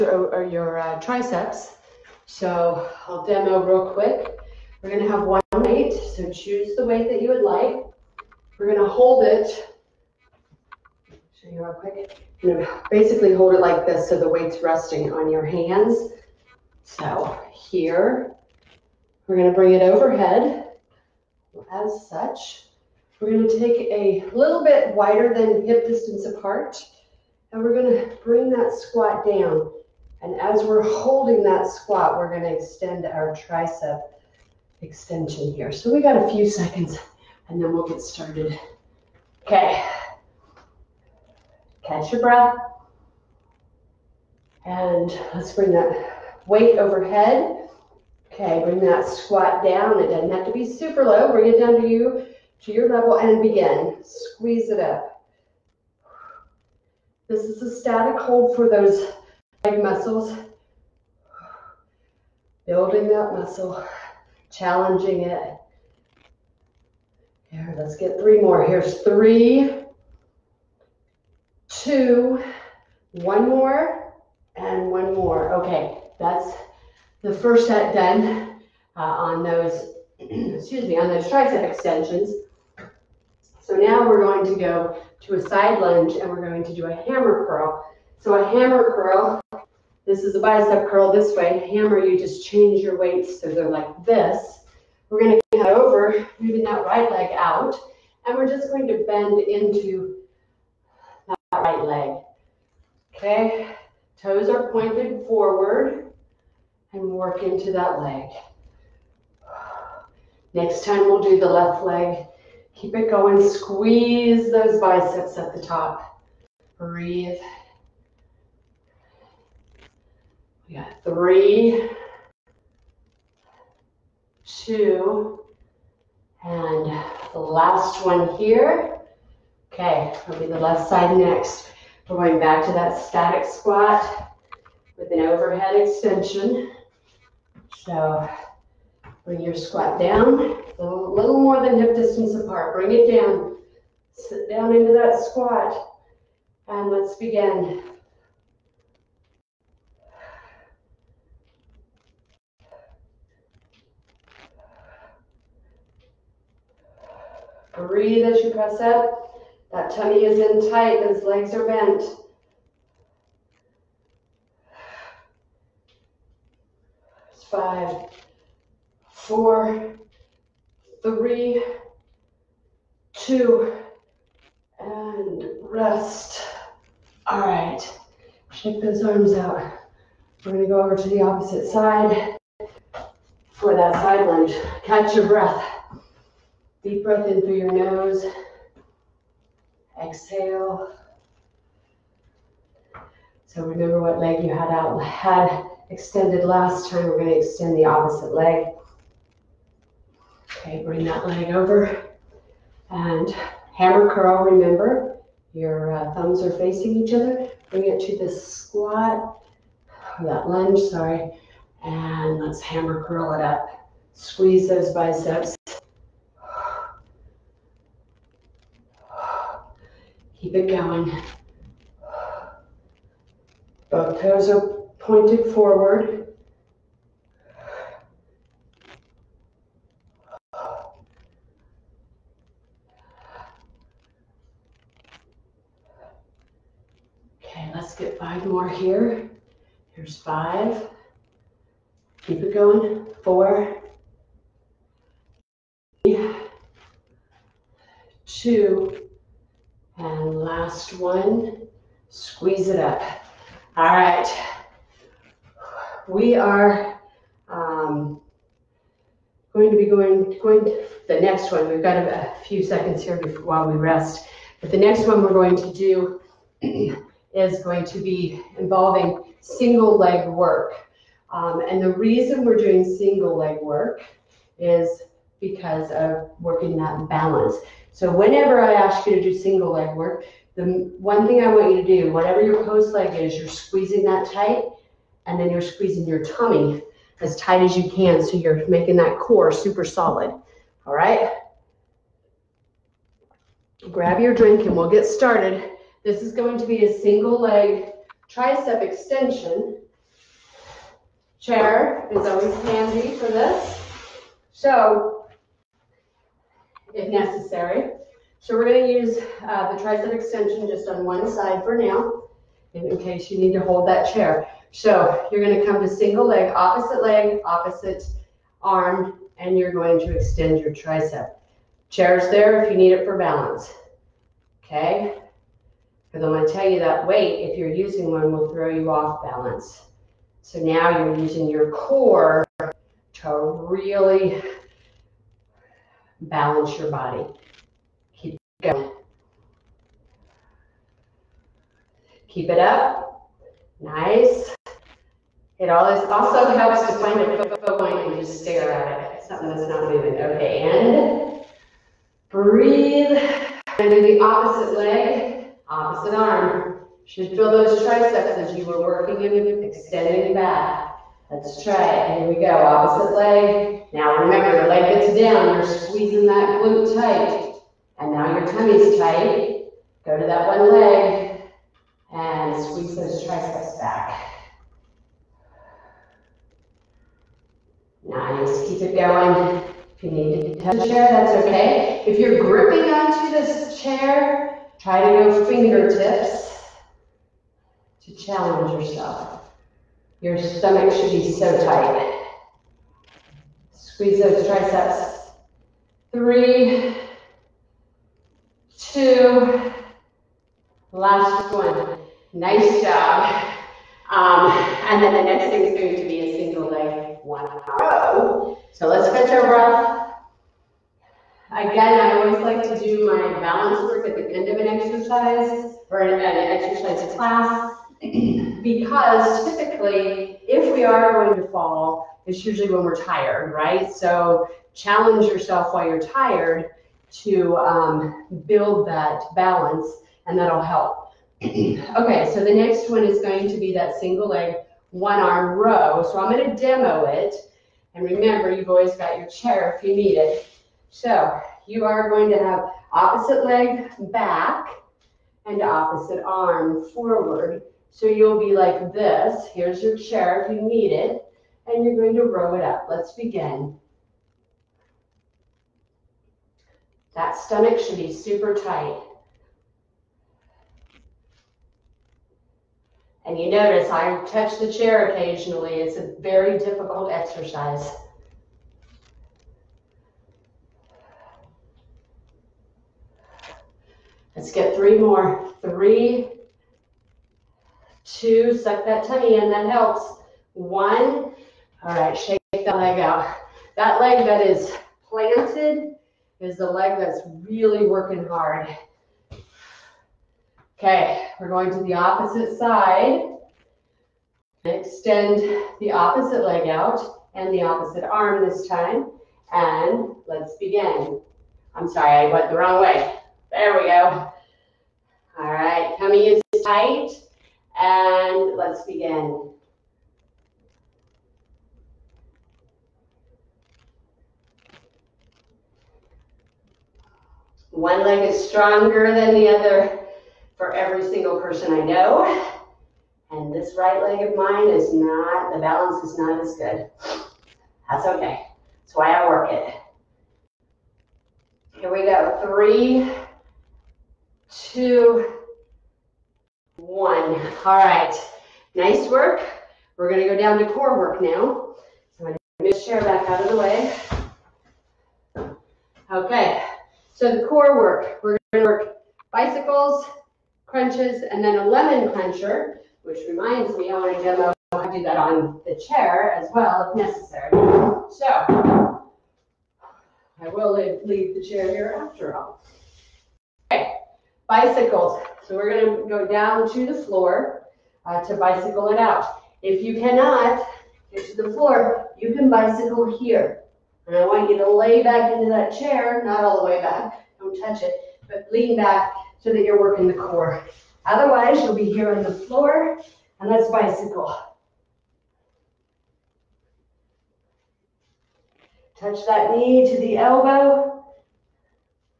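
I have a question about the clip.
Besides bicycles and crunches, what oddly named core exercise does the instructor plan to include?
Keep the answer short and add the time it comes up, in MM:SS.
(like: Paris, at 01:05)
Lemon clencher, at 09:11.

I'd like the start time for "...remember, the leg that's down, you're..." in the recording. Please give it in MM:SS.
06:04.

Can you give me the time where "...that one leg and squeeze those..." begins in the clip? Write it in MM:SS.
06:10.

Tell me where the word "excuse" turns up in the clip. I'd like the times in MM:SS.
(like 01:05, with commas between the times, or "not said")
01:20.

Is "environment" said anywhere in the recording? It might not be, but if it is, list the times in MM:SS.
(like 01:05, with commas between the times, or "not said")
not said.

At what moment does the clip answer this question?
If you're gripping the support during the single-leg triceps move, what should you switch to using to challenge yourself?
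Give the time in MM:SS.
06:25.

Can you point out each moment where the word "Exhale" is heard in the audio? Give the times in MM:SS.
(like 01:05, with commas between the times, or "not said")
03:10.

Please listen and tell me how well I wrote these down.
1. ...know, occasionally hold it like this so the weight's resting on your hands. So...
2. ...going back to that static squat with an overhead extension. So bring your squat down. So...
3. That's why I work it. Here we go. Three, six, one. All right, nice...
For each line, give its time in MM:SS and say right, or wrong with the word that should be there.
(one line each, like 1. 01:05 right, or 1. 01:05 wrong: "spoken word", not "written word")
1. 00:12 wrong: "basically", not "occasionally"
2. 02:12 right
3. 08:48 wrong: "two", not "six".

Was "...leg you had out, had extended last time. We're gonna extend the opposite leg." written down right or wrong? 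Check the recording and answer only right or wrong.
right.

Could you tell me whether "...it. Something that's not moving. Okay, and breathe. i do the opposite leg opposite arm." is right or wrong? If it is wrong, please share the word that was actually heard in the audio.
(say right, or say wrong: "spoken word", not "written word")
right.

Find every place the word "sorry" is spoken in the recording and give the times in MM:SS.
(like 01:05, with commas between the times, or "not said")
03:30, 08:21.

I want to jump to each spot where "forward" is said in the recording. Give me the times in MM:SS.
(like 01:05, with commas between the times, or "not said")
01:45, 03:45, 07:26.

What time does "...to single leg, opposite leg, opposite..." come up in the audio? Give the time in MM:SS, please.
05:15.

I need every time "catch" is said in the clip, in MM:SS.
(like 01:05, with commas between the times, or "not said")
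00:41, 03:04, 06:49.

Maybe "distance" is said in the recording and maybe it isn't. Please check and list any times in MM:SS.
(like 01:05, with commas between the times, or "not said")
00:25, 02:21.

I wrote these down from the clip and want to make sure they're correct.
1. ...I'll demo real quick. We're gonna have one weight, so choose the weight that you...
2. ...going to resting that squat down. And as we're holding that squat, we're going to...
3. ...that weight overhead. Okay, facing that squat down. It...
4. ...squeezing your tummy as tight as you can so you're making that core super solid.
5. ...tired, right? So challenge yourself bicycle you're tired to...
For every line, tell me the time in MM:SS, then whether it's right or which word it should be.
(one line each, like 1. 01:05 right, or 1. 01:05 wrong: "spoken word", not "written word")
1. 00:03 right
2. 00:27 wrong: "bring", not "resting"
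3. 00:45 wrong: "bring", not "facing"
4. 04:45 right
5. 07:02 wrong: "while", not "bicycle".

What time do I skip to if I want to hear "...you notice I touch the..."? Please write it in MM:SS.
07:43.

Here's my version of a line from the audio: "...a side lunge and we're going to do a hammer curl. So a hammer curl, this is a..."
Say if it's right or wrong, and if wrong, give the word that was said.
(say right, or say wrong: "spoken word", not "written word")
right.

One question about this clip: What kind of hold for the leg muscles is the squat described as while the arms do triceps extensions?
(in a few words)
Static hold.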